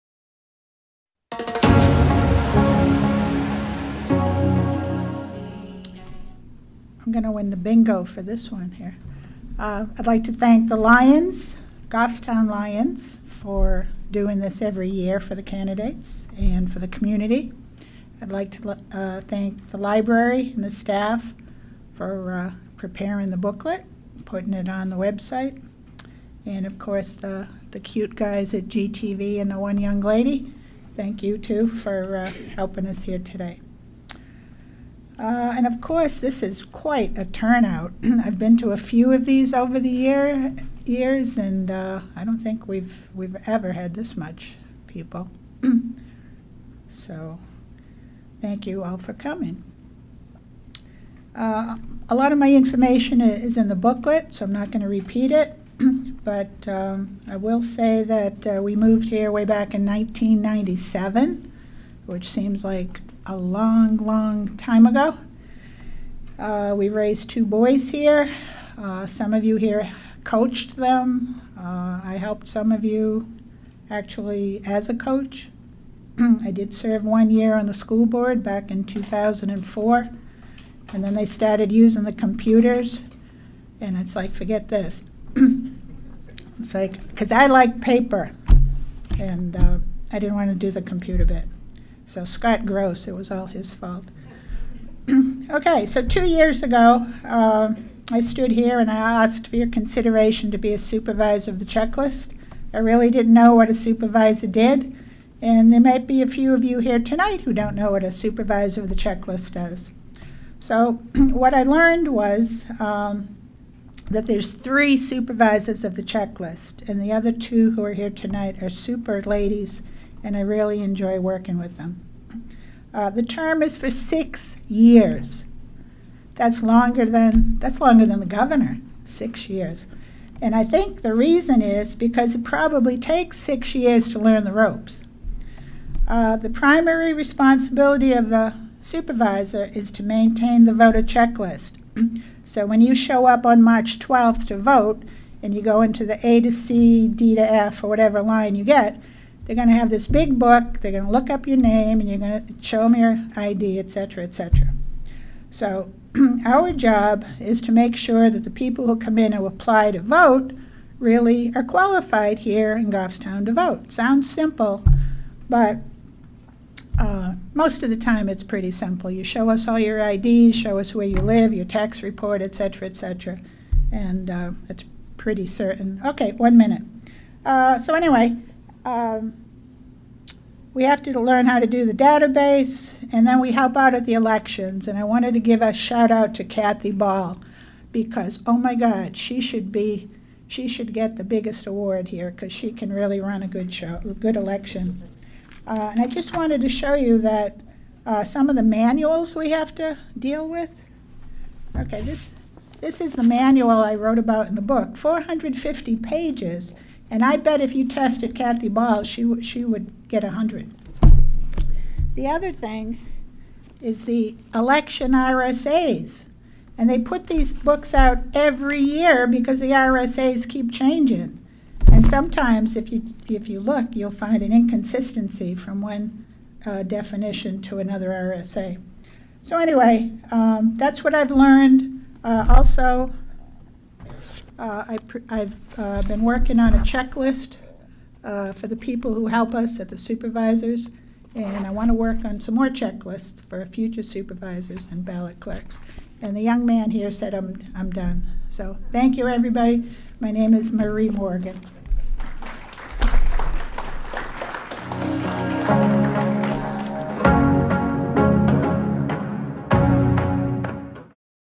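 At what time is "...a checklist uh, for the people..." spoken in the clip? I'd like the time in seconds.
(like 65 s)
236 s.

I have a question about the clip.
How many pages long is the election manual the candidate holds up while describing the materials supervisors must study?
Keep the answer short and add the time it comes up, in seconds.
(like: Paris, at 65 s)
450, at 204 s.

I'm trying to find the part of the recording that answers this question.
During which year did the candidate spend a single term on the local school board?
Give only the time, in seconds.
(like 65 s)
78 s.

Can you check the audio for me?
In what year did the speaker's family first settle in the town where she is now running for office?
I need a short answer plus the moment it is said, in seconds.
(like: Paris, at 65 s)
1997, at 59 s.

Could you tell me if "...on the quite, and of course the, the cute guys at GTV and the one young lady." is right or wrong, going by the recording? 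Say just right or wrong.
wrong.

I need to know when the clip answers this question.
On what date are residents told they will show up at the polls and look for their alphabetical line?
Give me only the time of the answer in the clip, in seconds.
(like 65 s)
143 s.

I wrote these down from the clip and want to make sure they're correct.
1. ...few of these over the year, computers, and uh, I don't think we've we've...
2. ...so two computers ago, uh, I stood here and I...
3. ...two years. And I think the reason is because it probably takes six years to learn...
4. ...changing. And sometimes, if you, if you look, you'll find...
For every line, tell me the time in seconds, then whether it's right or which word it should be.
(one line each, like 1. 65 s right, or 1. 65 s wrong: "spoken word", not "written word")
1. 38 s wrong: "years", not "computers"
2. 95 s wrong: "years", not "computers"
3. 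129 s wrong: "six", not "two"
4. 220 s right.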